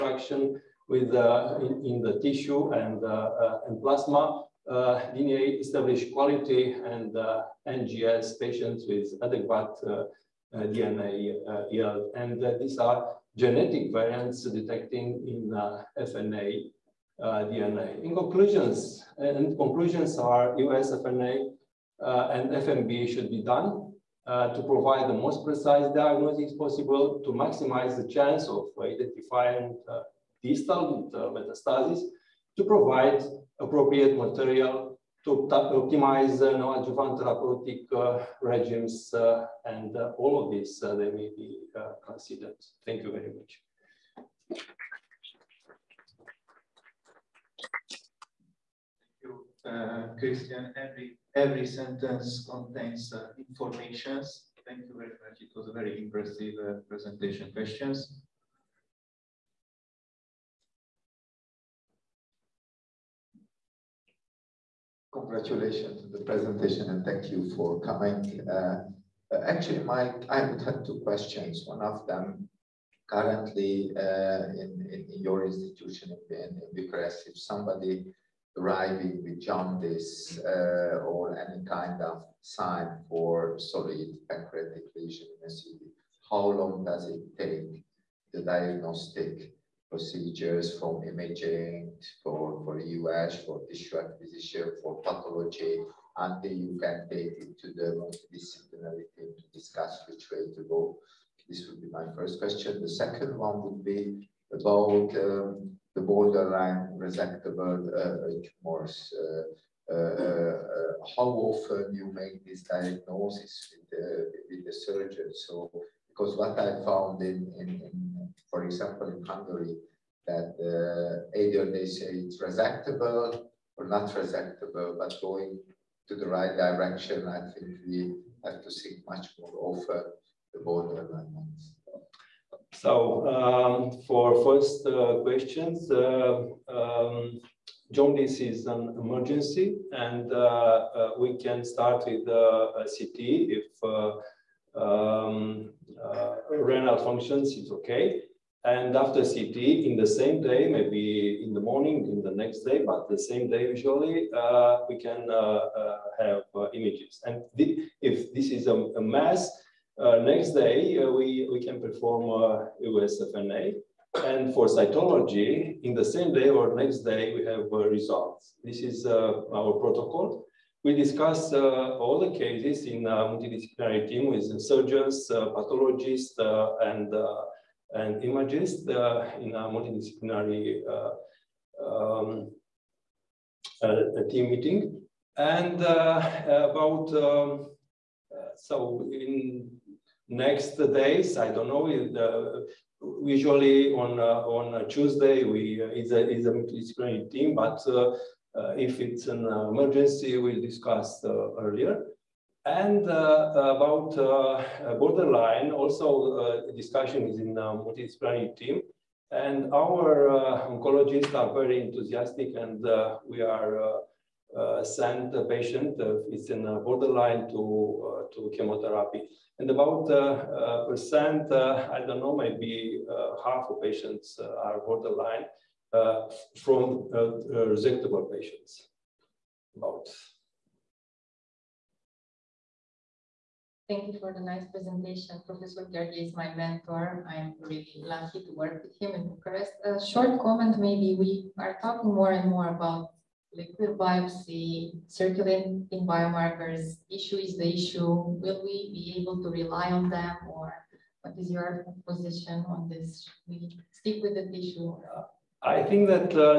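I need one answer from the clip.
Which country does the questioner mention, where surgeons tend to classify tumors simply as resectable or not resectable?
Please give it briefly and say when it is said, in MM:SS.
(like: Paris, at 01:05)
Hungary, at 01:59.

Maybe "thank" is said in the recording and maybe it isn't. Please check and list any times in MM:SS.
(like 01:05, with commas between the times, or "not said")
00:42, 00:54, 01:07, 03:53.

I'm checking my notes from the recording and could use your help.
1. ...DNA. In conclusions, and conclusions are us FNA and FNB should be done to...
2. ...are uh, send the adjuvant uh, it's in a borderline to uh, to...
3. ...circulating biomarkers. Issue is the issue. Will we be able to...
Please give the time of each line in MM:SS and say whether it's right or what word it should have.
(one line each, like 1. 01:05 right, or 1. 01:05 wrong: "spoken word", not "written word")
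1. 00:17 right
2. 03:33 wrong: "patient", not "adjuvant"
3. 04:05 right.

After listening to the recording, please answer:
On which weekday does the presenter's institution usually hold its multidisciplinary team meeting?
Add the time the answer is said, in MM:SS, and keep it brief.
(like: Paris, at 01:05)
Tuesday, at 03:14.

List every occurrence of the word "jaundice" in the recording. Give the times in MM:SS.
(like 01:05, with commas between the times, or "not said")
01:19, 02:17.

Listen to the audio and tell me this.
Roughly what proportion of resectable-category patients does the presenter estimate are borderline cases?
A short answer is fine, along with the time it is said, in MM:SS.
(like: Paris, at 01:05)
half, at 03:43.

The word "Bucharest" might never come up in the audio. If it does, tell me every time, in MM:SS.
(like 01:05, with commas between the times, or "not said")
01:16, 03:59.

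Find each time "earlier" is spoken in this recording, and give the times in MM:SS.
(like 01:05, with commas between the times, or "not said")
03:21.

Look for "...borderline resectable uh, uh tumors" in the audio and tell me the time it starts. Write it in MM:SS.
01:46.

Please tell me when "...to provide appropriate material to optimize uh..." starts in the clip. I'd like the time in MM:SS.
00:32.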